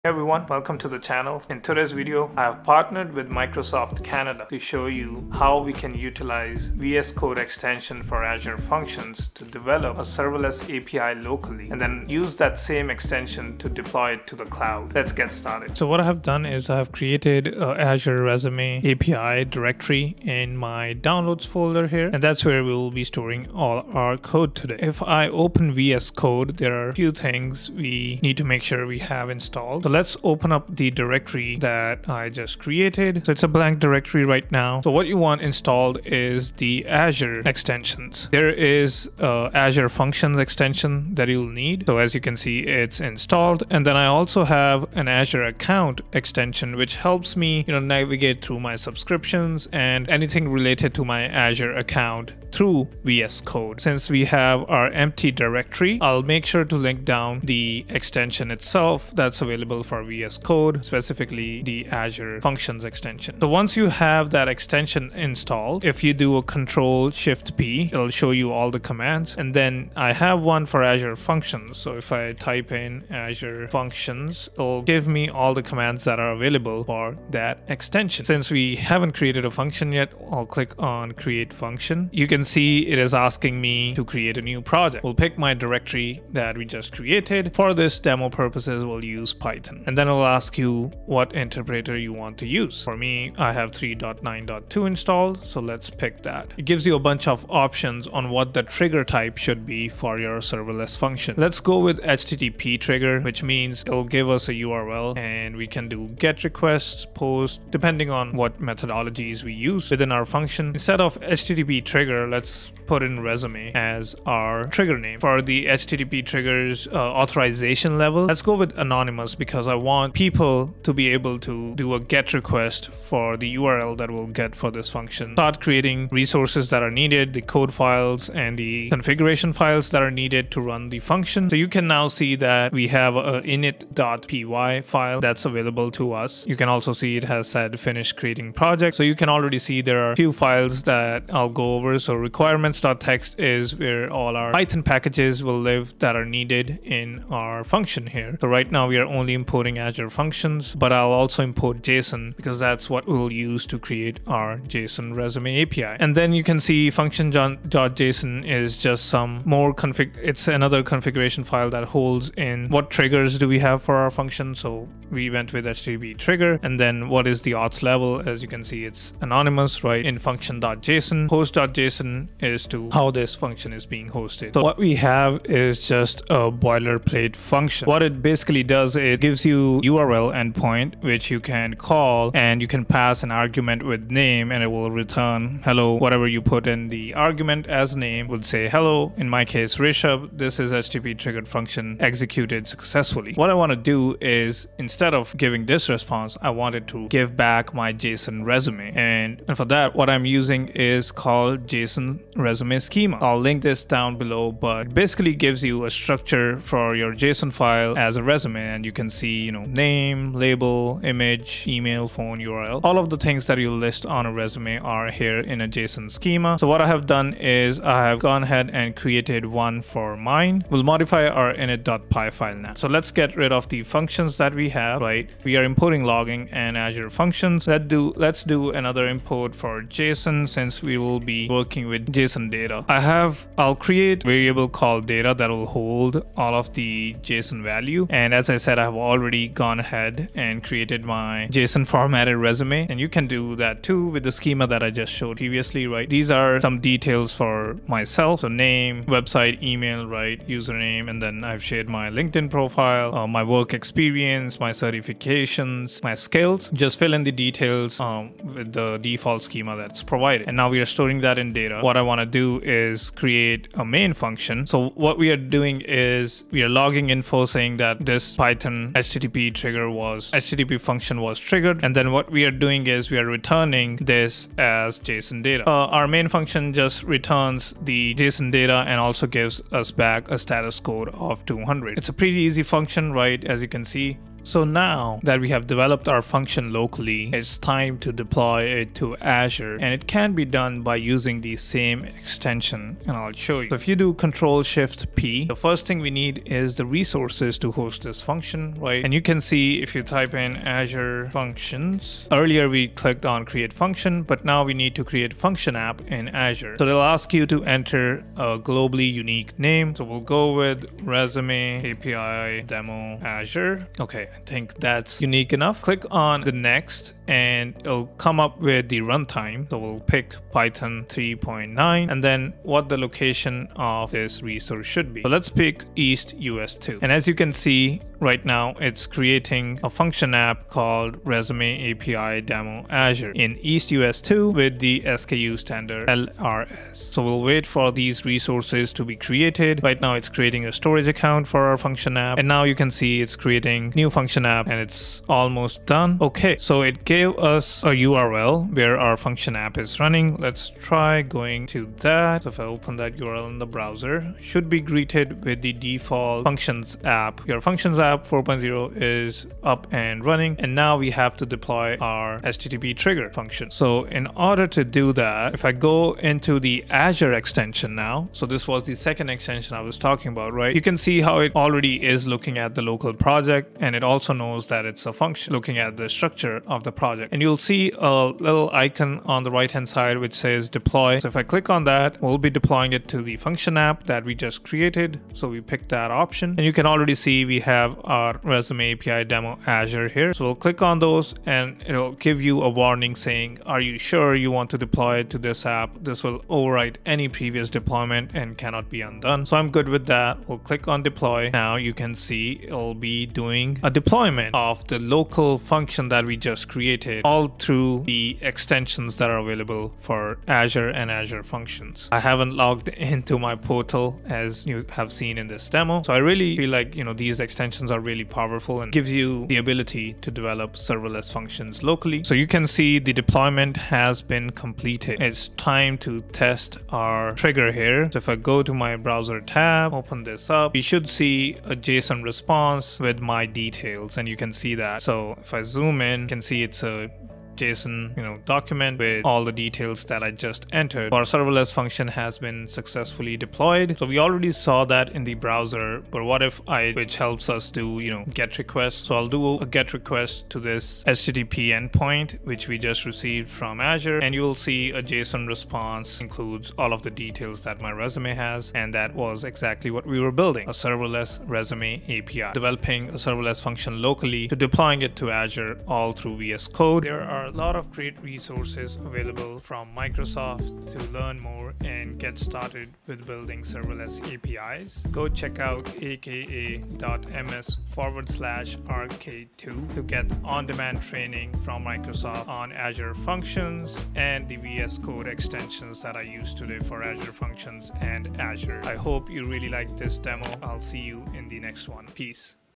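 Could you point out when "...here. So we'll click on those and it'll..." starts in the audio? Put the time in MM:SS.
06:30.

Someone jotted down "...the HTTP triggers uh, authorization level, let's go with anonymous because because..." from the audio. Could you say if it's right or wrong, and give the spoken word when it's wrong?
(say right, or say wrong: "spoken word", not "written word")
right.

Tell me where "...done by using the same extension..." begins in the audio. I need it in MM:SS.
04:50.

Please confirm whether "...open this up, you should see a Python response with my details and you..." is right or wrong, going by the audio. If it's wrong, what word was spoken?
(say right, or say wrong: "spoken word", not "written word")
wrong: "JSON", not "Python".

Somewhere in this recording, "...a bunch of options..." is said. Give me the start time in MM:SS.
01:36.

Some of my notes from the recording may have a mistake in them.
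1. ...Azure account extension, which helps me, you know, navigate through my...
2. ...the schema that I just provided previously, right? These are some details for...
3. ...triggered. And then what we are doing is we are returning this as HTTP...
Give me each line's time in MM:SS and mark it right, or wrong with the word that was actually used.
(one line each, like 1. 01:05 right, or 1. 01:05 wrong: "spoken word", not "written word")
1. 00:45 right
2. 04:04 wrong: "showed", not "provided"
3. 04:31 wrong: "JSON", not "HTTP".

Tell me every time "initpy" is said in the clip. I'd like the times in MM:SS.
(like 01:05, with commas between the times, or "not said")
02:13, 03:41.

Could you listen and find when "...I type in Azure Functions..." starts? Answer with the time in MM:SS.
01:12.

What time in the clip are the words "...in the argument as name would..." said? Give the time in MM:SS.
03:06.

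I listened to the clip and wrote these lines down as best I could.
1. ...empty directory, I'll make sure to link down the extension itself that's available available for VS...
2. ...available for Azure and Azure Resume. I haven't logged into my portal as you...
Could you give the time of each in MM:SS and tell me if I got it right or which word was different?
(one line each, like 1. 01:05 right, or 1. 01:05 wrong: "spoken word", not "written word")
1. 00:54 right
2. 06:49 wrong: "Functions", not "Resume".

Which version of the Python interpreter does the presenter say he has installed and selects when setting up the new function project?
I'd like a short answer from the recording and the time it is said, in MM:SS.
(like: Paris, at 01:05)
3.9.2, at 01:33.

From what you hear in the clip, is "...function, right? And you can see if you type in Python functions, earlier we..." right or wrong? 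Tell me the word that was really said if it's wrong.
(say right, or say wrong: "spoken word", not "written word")
wrong: "Azure", not "Python".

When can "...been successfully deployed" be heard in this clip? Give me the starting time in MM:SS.
07:22.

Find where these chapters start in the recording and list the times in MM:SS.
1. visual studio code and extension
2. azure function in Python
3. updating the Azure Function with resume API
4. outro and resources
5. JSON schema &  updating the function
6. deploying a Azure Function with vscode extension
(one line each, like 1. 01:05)
1. 00:15
2. 02:13
3. 06:05
4. 07:47
5. 03:13
6. 04:48.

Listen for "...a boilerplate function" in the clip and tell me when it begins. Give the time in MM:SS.
02:56.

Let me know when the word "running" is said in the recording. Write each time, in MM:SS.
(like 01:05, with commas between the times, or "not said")
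05:49, 06:00.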